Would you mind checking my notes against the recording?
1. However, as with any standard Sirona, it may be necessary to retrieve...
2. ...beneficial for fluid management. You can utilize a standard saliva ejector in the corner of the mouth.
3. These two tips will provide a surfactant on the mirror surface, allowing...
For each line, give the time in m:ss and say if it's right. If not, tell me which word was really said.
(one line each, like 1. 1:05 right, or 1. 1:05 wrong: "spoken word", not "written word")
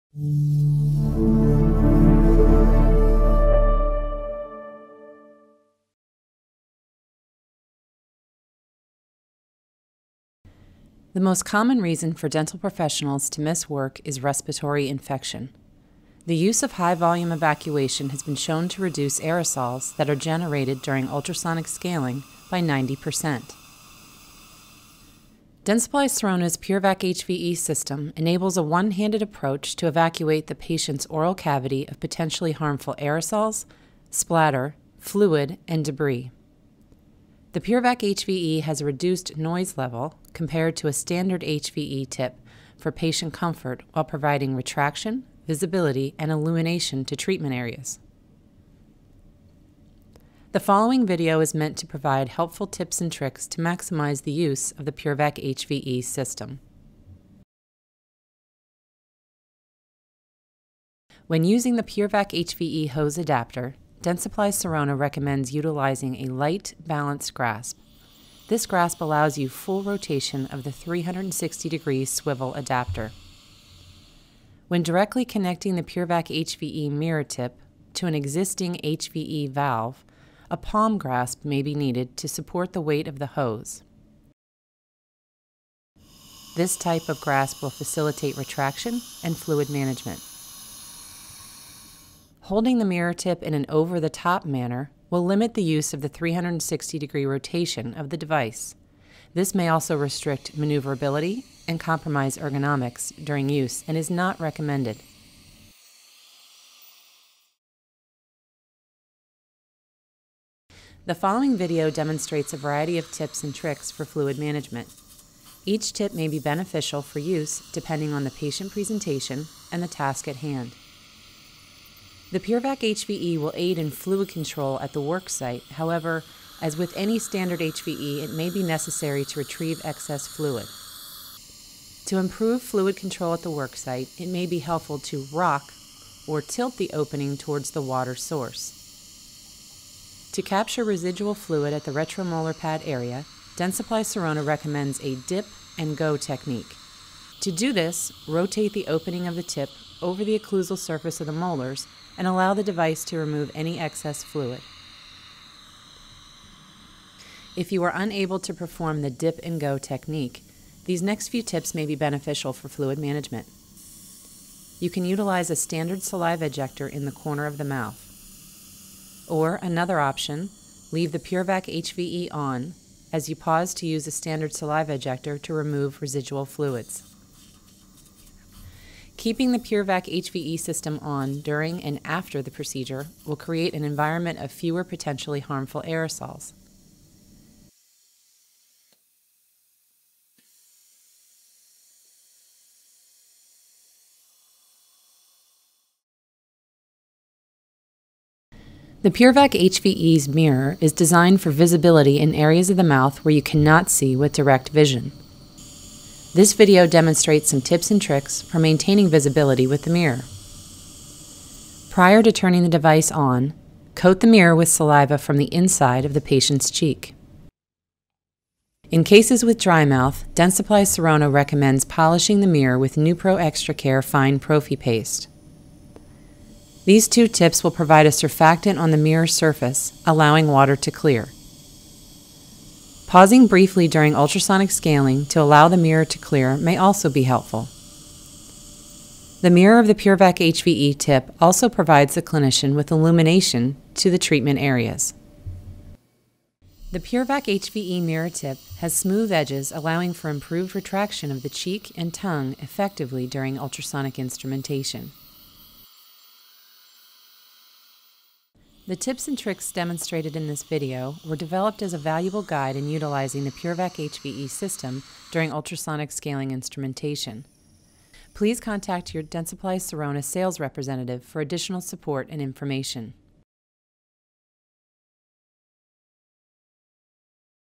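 1. 2:05 wrong: "HVE", not "Sirona"
2. 2:41 right
3. 3:46 right.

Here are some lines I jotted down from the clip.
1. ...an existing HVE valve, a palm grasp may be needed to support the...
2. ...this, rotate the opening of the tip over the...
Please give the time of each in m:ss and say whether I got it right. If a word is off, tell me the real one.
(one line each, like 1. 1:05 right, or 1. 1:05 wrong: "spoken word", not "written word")
1. 1:18 right
2. 2:27 right.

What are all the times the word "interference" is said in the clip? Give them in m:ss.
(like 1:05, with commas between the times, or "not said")
not said.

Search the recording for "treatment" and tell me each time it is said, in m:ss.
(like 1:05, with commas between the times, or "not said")
0:47, 4:04.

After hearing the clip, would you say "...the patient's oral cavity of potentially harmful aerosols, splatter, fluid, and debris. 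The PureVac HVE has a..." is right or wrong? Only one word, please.
right.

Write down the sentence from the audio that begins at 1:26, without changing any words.
This type of grasp will facilitate retraction and fluid management.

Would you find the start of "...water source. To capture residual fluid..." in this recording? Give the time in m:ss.
2:17.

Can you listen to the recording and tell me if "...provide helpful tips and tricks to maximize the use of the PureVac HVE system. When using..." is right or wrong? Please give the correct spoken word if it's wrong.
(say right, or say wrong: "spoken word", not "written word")
right.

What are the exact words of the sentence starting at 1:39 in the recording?
This may also restrict maneuverability and compromise ergonomics during use and is not recommended.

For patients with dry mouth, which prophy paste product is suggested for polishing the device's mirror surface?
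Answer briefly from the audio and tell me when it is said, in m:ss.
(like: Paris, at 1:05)
NuPro Extra Care Fine Prophy Paste, at 3:42.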